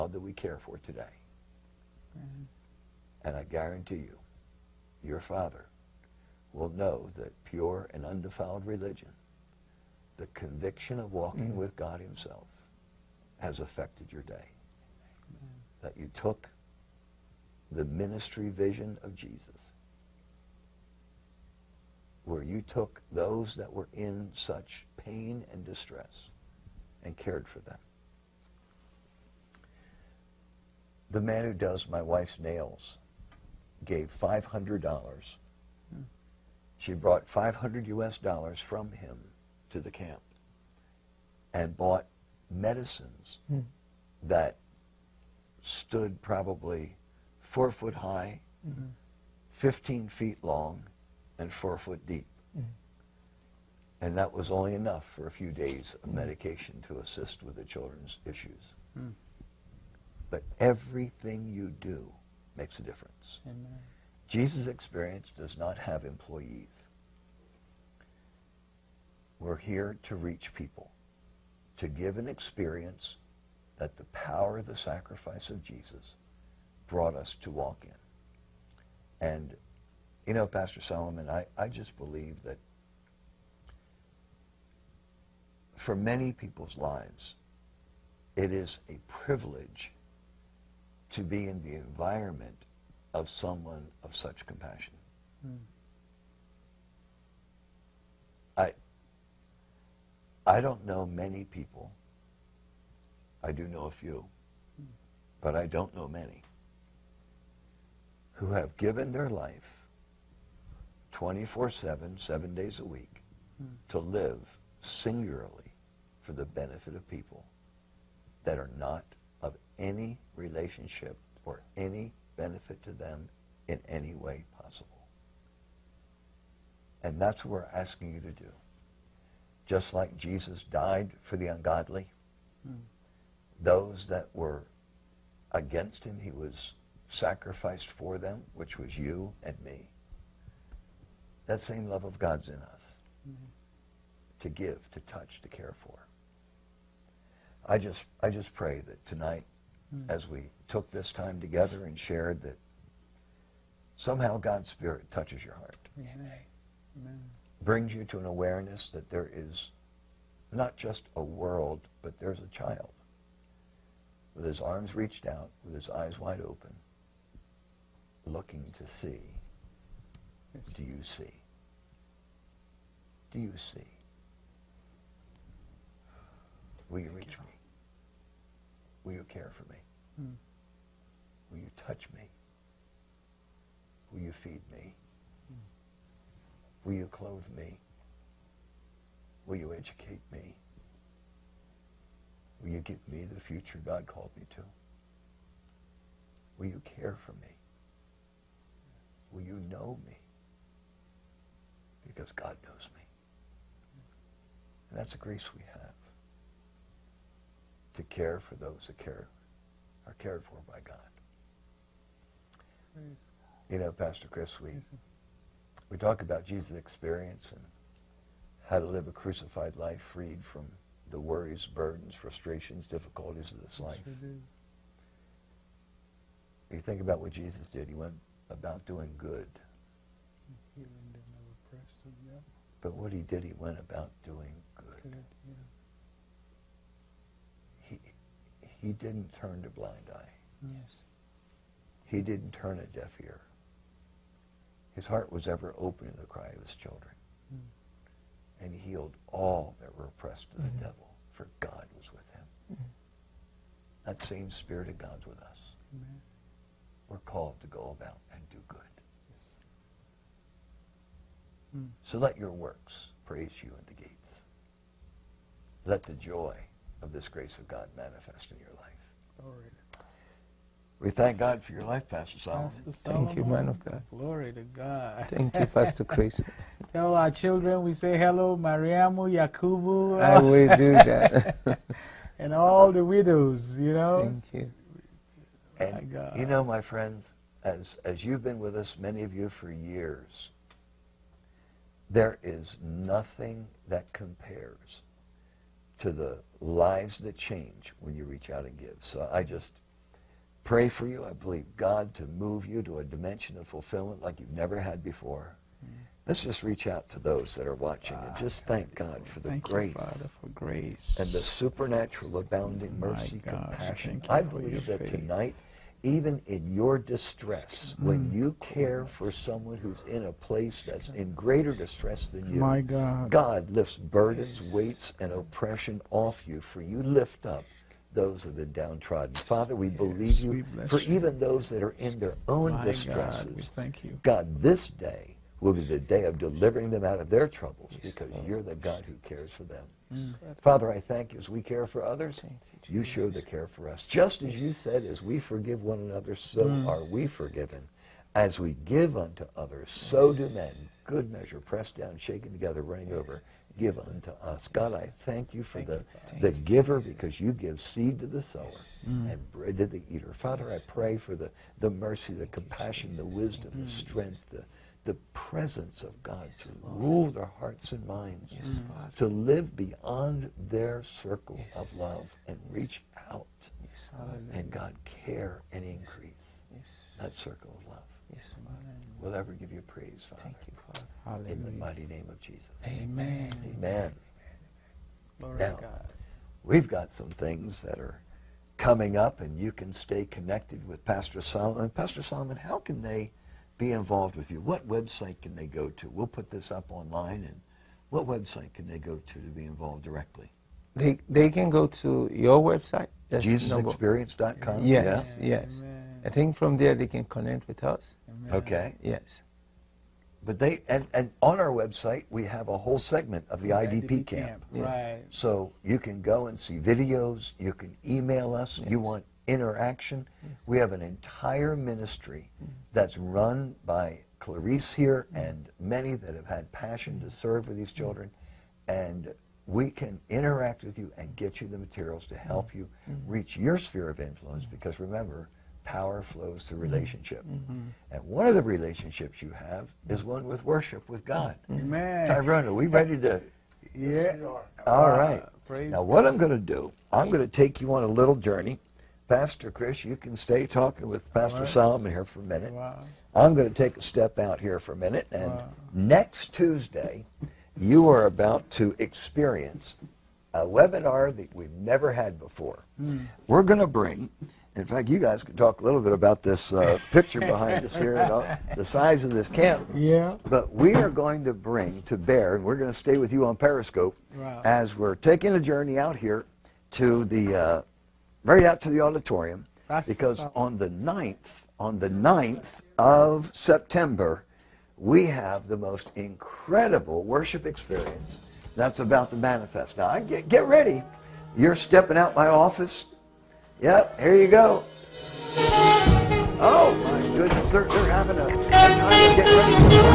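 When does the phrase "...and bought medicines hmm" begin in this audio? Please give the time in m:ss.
0:41.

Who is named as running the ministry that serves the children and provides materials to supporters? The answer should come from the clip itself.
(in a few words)
Clarice.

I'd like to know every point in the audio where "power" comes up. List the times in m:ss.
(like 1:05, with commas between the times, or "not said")
1:14, 7:15.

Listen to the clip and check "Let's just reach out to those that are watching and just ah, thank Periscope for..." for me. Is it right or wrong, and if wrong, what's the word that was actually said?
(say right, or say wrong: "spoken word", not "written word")
wrong: "God", not "Periscope".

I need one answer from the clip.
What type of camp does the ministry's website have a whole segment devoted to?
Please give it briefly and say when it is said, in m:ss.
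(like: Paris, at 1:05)
IDP camp, at 6:54.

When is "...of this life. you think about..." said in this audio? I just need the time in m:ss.
3:43.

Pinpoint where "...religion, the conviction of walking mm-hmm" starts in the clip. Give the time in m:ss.
0:08.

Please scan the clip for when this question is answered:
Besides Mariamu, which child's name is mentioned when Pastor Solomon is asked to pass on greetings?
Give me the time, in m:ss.
4:39.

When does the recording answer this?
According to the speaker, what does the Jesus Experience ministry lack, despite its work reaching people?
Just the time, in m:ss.
1:06.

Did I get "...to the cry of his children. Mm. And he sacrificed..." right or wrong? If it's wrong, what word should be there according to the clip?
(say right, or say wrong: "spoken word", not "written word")
wrong: "healed", not "sacrificed".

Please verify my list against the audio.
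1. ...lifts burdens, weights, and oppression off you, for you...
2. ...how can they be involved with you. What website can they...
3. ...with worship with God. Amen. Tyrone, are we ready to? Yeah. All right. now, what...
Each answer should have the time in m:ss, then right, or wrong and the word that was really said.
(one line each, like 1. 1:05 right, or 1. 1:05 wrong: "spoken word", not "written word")
1. 5:23 right
2. 6:32 right
3. 7:20 right.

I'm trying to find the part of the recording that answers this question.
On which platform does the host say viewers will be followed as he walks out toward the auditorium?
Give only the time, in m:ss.
7:53.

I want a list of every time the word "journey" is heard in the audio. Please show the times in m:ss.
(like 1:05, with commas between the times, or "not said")
7:28, 7:55.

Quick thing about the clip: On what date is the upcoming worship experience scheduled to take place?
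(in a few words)
9 September.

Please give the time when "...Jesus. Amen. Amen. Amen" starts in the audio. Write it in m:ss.
6:22.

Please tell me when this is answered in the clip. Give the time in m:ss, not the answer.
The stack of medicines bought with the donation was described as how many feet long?
0:49.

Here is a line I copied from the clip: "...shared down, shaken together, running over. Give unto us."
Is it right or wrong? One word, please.
wrong.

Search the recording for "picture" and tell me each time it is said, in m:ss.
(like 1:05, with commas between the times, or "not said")
7:47.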